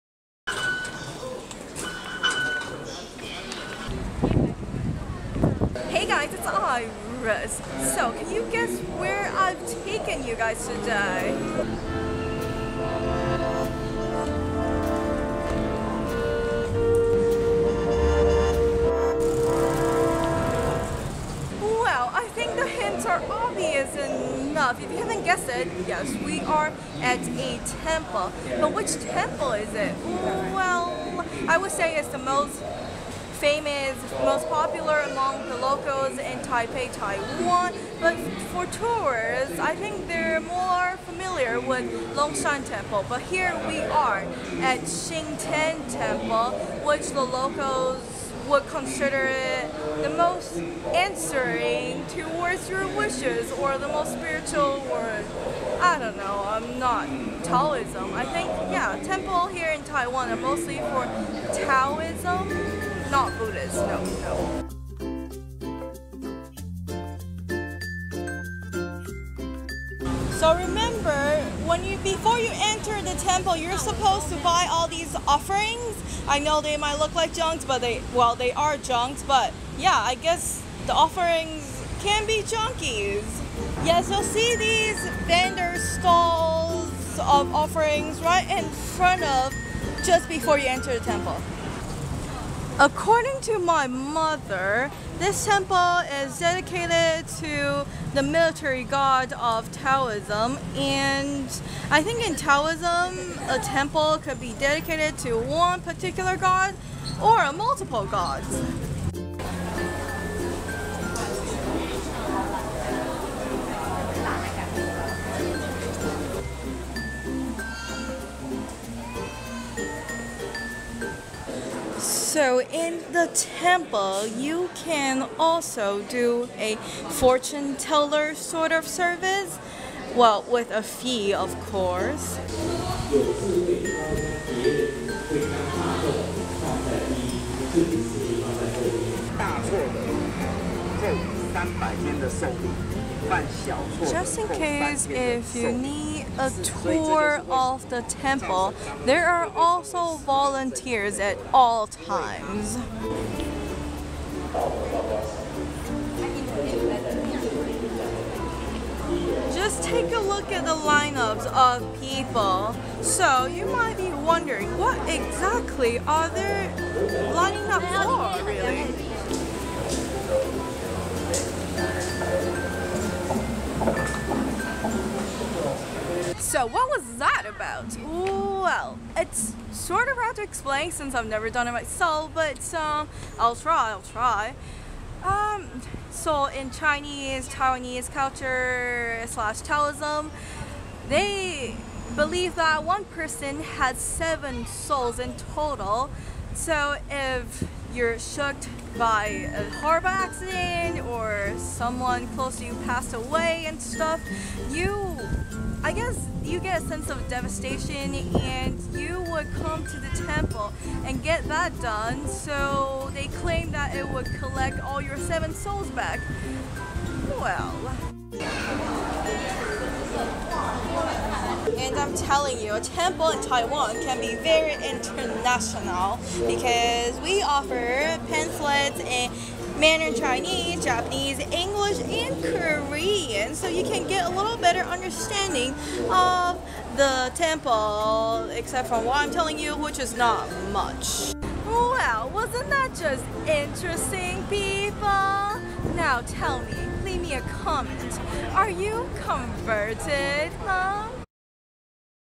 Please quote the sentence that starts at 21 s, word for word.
Well, I think the hints are obvious enough.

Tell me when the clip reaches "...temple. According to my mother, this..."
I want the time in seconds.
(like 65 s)
91 s.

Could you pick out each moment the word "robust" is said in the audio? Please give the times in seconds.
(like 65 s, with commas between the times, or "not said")
not said.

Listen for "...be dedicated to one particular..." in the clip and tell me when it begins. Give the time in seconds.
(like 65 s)
104 s.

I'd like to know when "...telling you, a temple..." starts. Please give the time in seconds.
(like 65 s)
222 s.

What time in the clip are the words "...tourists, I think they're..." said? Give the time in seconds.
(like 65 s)
38 s.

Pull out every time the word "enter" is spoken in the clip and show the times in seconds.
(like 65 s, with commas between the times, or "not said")
72 s, 90 s.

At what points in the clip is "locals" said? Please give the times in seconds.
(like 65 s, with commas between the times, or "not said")
35 s, 47 s.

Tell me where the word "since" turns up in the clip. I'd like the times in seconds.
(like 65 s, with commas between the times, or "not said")
180 s.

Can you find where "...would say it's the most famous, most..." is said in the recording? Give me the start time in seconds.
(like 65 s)
31 s.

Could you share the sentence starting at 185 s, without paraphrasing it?
Um, so in Chinese, Taiwanese culture slash Taoism, they believe that one person has seven souls in total.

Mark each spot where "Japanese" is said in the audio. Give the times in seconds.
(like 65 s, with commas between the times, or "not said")
230 s.